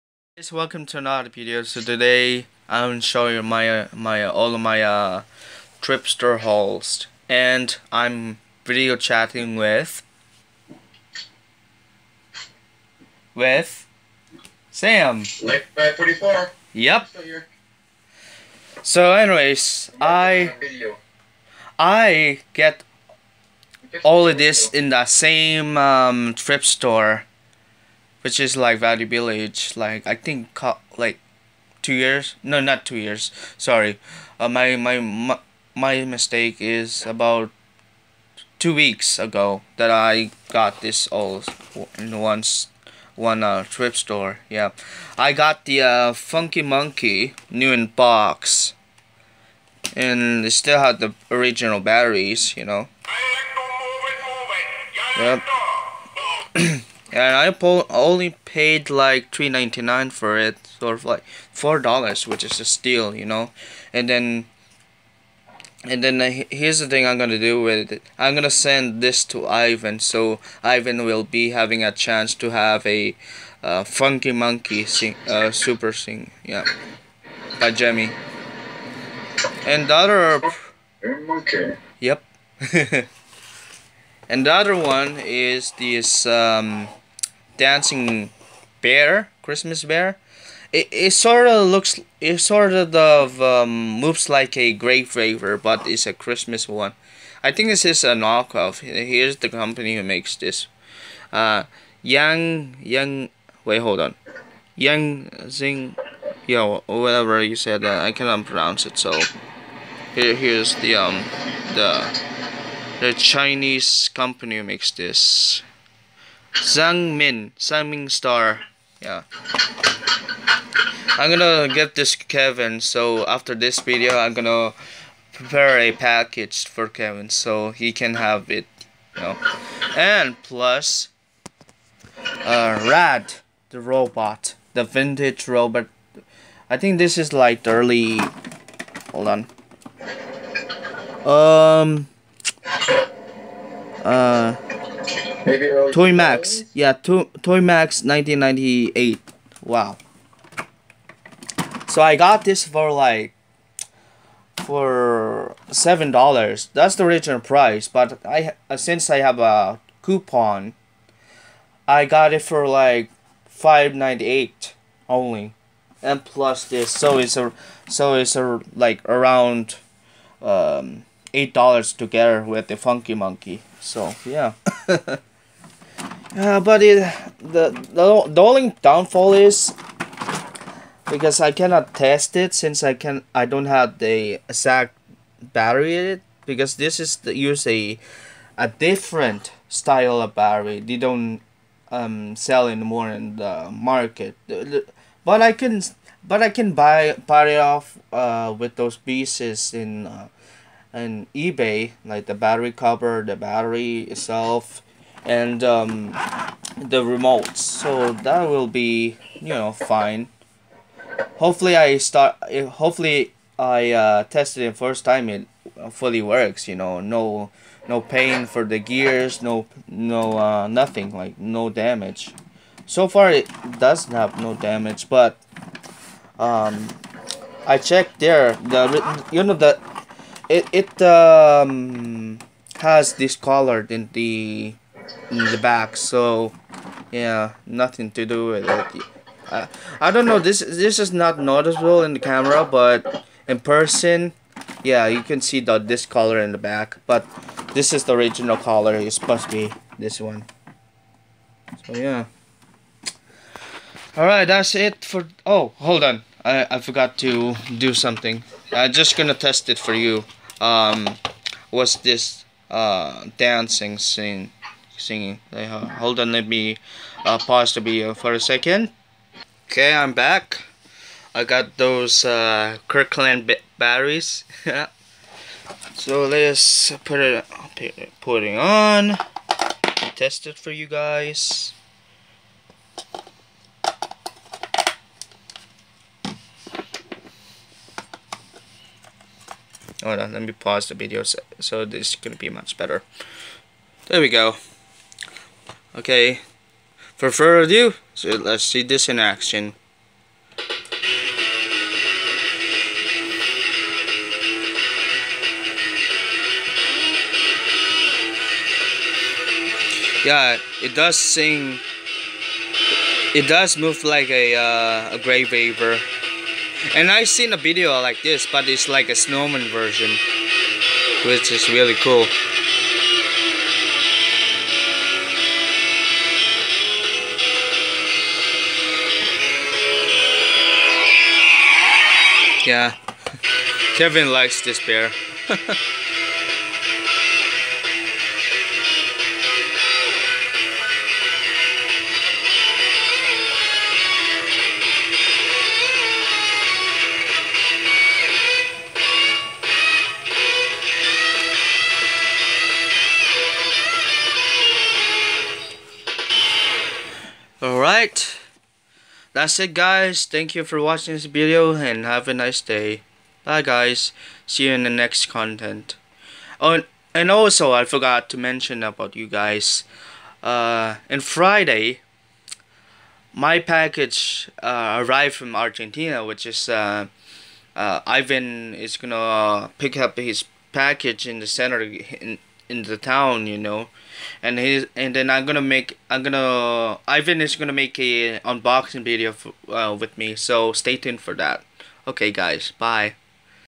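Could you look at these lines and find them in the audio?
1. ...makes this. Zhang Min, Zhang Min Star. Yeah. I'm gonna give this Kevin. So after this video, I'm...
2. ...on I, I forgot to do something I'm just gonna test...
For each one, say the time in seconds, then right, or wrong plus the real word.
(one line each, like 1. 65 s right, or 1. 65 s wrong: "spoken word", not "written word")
1. 114 s right
2. 256 s right.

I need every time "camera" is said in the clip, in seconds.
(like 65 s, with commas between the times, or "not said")
242 s.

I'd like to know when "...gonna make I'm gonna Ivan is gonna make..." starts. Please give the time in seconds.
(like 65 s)
385 s.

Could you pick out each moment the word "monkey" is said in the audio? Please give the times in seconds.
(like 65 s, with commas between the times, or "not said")
46 s, 74 s, 173 s.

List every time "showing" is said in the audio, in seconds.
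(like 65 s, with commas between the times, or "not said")
3 s.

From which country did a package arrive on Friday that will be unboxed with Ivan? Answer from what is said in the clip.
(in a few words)
Argentina.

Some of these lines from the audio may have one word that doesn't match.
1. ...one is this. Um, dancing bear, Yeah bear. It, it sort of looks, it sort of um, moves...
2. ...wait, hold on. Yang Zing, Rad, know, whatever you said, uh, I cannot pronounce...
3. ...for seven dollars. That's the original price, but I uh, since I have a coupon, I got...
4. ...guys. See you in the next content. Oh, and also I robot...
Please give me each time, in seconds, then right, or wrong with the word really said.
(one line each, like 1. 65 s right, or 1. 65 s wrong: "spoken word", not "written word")
1. 84 s wrong: "Christmas", not "Yeah"
2. 103 s wrong: "Yeah", not "Rad"
3. 154 s right
4. 363 s wrong: "forgot", not "robot".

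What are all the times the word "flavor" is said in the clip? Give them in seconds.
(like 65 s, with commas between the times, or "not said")
95 s.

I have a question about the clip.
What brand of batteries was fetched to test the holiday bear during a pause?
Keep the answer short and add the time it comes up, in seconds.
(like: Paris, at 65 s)
Kirkland, at 272 s.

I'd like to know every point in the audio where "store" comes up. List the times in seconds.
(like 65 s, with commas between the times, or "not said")
26 s, 43 s.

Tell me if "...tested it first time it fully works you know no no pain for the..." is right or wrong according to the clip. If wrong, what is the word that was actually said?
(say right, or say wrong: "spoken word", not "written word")
right.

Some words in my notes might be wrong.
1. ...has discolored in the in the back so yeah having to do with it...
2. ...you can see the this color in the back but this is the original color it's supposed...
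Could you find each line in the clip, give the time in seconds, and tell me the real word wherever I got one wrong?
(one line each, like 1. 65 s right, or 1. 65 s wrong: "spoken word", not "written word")
1. 232 s wrong: "nothing", not "having"
2. 245 s right.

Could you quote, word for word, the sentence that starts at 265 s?
Uh, hold on, let me uh, pause the video for a second.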